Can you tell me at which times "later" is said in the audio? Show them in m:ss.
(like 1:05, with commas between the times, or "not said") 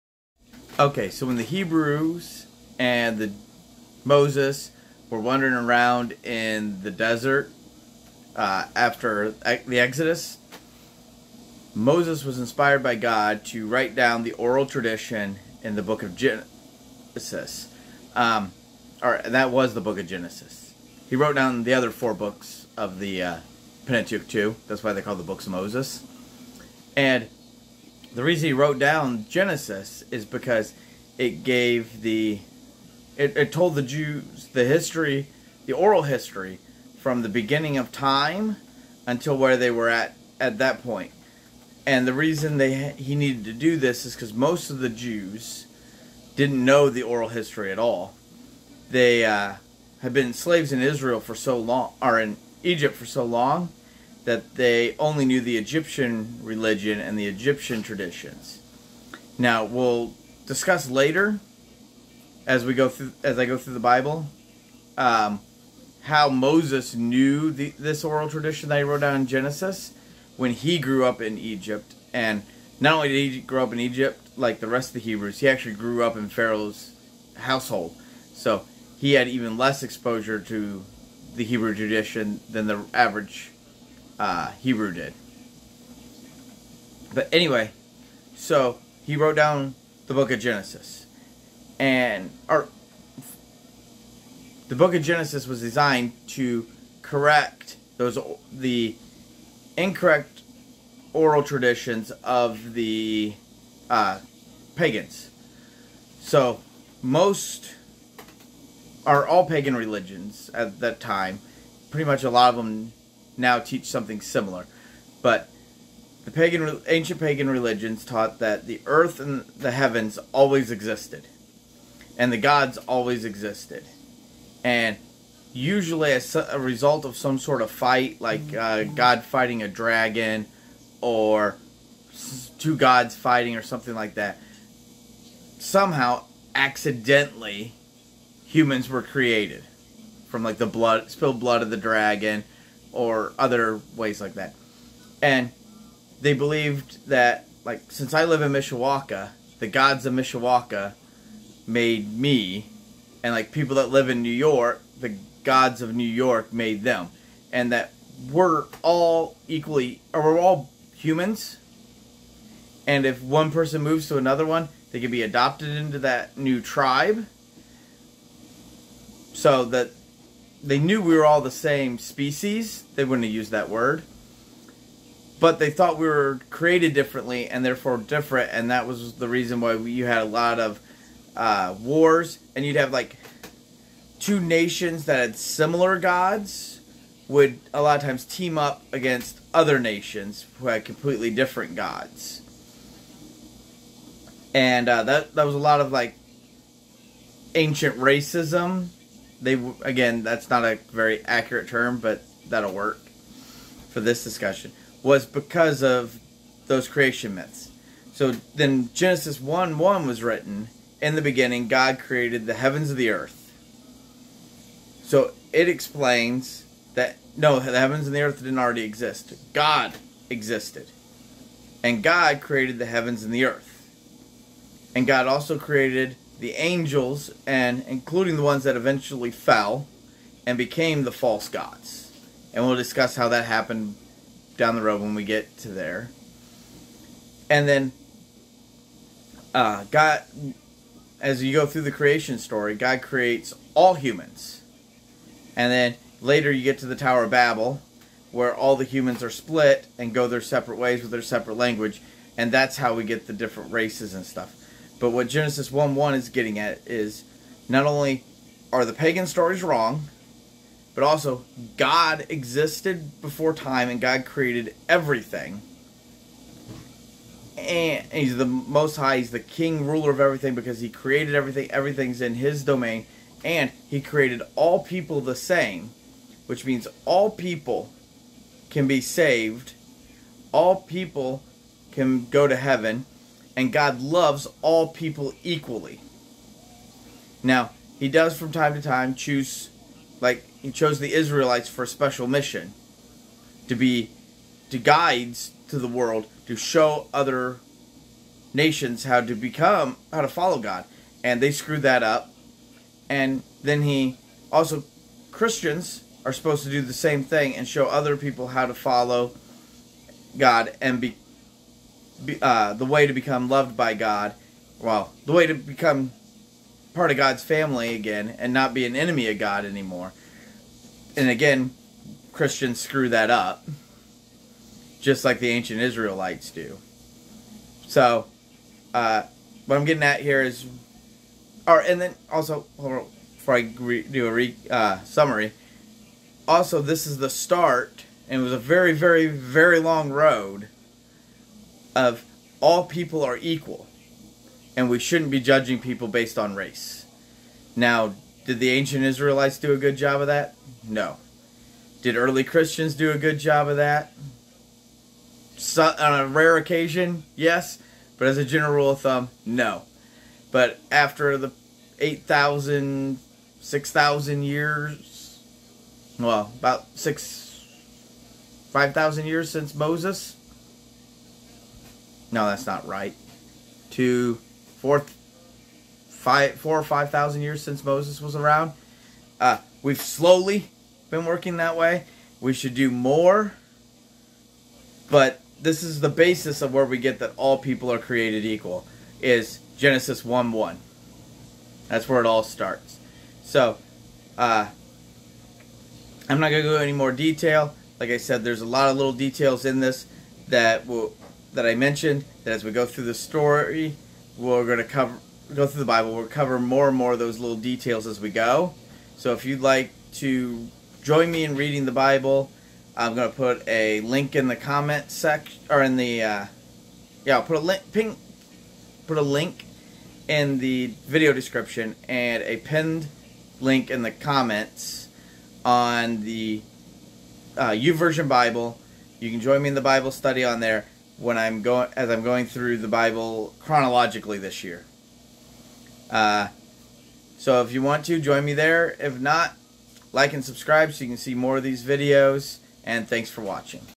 1:00, 4:06.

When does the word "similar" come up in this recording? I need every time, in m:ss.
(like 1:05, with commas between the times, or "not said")
1:54, 3:05.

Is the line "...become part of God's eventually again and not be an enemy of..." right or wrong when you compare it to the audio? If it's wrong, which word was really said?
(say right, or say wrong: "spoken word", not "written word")
wrong: "family", not "eventually".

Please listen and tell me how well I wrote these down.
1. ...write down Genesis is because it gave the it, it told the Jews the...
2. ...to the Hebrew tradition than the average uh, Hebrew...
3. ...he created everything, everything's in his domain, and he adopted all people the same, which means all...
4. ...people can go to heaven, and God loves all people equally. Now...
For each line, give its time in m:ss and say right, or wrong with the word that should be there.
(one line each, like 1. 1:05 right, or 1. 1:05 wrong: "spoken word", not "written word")
1. 0:28 wrong: "wrote", not "write"
2. 1:20 right
3. 4:30 wrong: "created", not "adopted"
4. 4:40 right.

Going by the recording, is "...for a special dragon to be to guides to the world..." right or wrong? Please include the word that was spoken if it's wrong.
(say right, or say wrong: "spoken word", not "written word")
wrong: "mission", not "dragon".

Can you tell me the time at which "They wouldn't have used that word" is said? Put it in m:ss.
2:52.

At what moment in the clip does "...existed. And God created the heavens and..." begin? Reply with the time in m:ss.
3:40.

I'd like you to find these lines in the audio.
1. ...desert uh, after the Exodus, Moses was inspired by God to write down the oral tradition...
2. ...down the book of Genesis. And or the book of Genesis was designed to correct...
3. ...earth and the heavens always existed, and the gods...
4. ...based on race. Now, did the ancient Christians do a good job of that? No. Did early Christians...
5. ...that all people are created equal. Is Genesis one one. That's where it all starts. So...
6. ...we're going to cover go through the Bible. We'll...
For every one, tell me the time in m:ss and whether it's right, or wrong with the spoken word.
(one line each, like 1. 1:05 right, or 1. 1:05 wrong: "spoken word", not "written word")
1. 0:06 right
2. 1:29 right
3. 1:58 right
4. 5:46 wrong: "Israelites", not "Christians"
5. 6:27 right
6. 6:44 right.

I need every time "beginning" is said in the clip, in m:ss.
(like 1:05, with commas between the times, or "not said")
0:37, 3:31.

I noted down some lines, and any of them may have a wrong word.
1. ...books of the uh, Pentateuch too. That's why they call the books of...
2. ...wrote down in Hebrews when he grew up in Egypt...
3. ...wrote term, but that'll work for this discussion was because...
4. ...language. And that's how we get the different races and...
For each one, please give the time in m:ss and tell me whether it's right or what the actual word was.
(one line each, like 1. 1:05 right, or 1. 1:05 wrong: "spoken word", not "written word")
1. 0:22 right
2. 1:08 wrong: "Genesis", not "Hebrews"
3. 3:21 wrong: "accurate", not "wrote"
4. 4:11 right.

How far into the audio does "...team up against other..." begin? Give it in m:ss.
3:08.